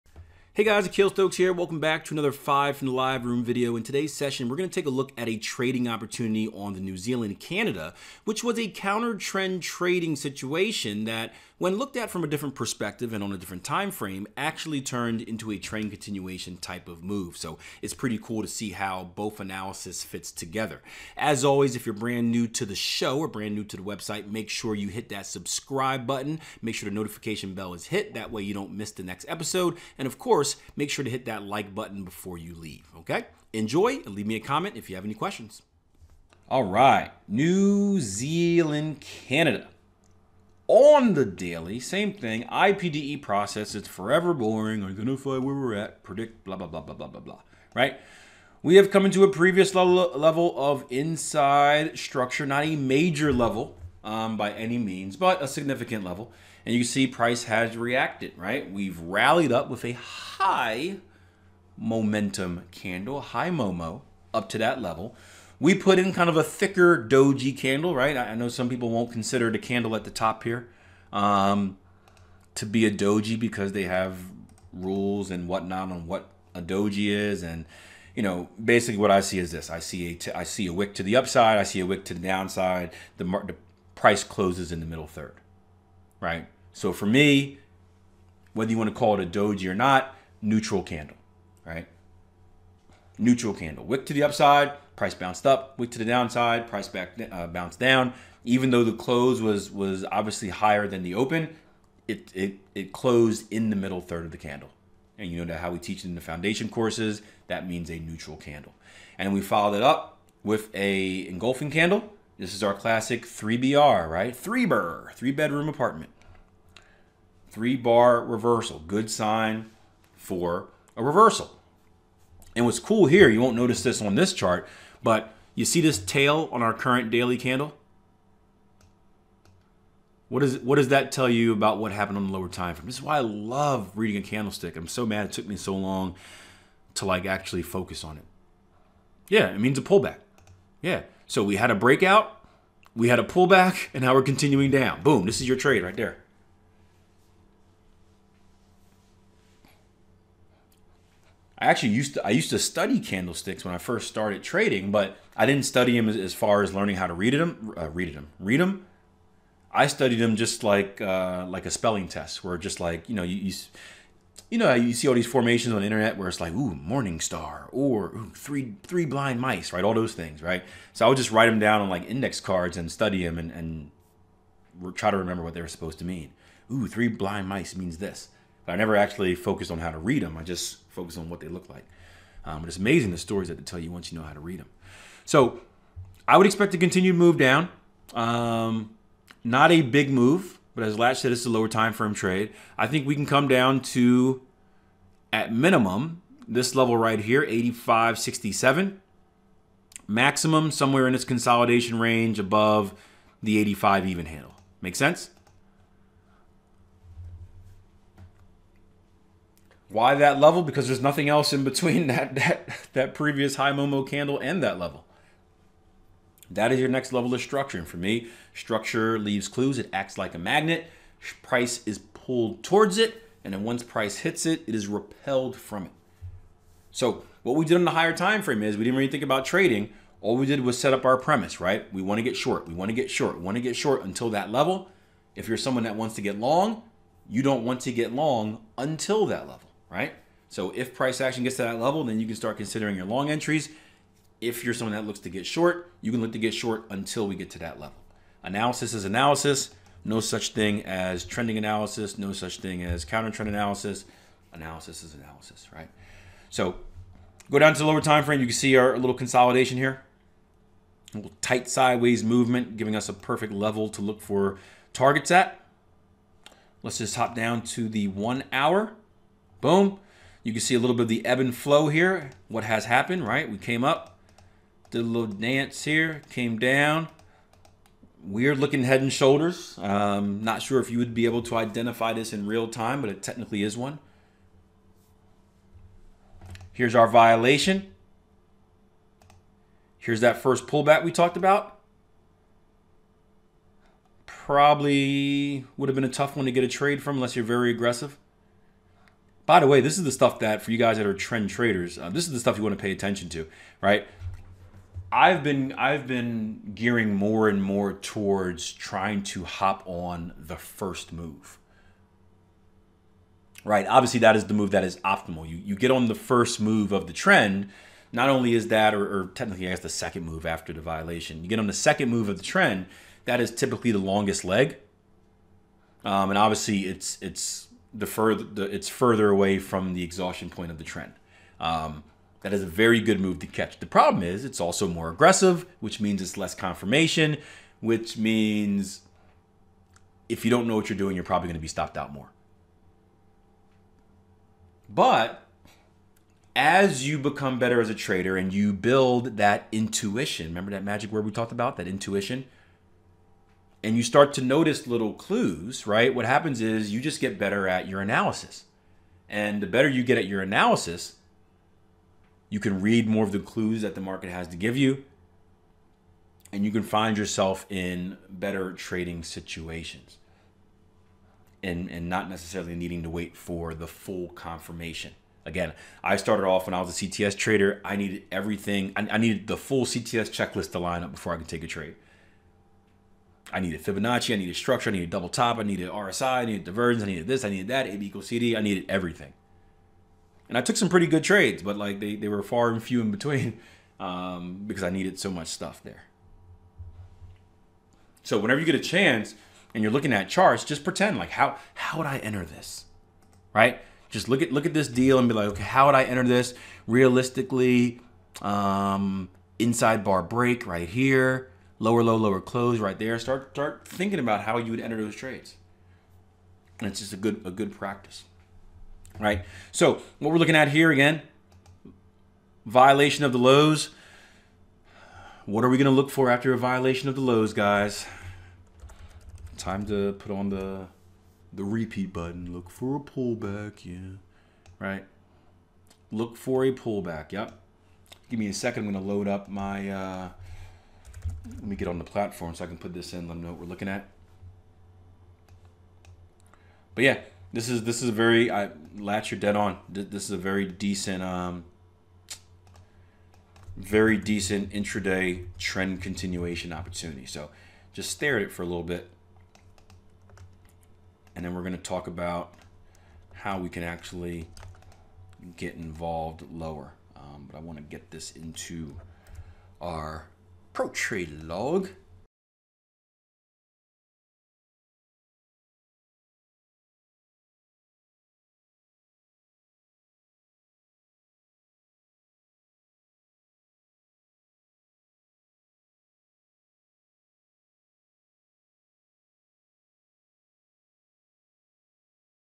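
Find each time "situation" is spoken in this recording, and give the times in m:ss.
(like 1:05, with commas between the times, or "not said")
0:10, 6:09.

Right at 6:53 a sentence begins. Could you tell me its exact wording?
Start start thinking about how you would enter those trades.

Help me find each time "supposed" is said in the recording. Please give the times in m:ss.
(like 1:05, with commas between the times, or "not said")
2:55.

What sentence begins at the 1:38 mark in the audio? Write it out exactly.
Even though the close was was obviously higher than the open, it it it closed in the middle third of the candle.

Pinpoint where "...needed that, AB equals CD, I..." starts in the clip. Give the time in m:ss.
6:27.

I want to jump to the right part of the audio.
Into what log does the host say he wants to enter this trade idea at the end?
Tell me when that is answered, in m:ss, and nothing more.
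7:50.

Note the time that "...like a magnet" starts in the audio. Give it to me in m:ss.
3:40.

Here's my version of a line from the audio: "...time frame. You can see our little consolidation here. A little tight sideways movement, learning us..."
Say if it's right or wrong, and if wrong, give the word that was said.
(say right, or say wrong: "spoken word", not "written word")
wrong: "giving", not "learning".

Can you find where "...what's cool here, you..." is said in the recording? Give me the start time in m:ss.
2:02.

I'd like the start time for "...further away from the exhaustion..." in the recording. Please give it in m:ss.
5:28.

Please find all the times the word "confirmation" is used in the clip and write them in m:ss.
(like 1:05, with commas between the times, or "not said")
5:36, 6:14.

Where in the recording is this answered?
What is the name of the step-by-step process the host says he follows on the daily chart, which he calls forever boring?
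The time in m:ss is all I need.
0:42.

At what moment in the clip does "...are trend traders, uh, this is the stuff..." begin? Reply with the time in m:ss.
5:01.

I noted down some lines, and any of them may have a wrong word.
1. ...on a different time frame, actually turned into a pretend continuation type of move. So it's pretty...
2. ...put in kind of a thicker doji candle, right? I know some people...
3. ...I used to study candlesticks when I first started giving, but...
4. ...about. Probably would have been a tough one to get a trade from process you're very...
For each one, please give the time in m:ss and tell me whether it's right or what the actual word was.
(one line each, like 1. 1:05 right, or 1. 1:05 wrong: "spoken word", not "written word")
1. 0:13 wrong: "trend", not "pretend"
2. 1:05 right
3. 2:32 wrong: "trading", not "giving"
4. 4:51 wrong: "unless", not "process".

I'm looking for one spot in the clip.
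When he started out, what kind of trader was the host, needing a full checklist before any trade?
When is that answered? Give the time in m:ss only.
6:17.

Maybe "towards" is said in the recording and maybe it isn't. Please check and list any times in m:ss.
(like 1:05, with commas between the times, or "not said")
3:42, 5:07.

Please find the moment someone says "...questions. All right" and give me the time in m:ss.
0:35.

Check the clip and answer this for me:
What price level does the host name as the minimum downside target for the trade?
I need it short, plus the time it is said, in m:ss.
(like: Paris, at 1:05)
85.67, at 3:17.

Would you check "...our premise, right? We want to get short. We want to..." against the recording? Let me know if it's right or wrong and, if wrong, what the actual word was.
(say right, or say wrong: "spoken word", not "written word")
right.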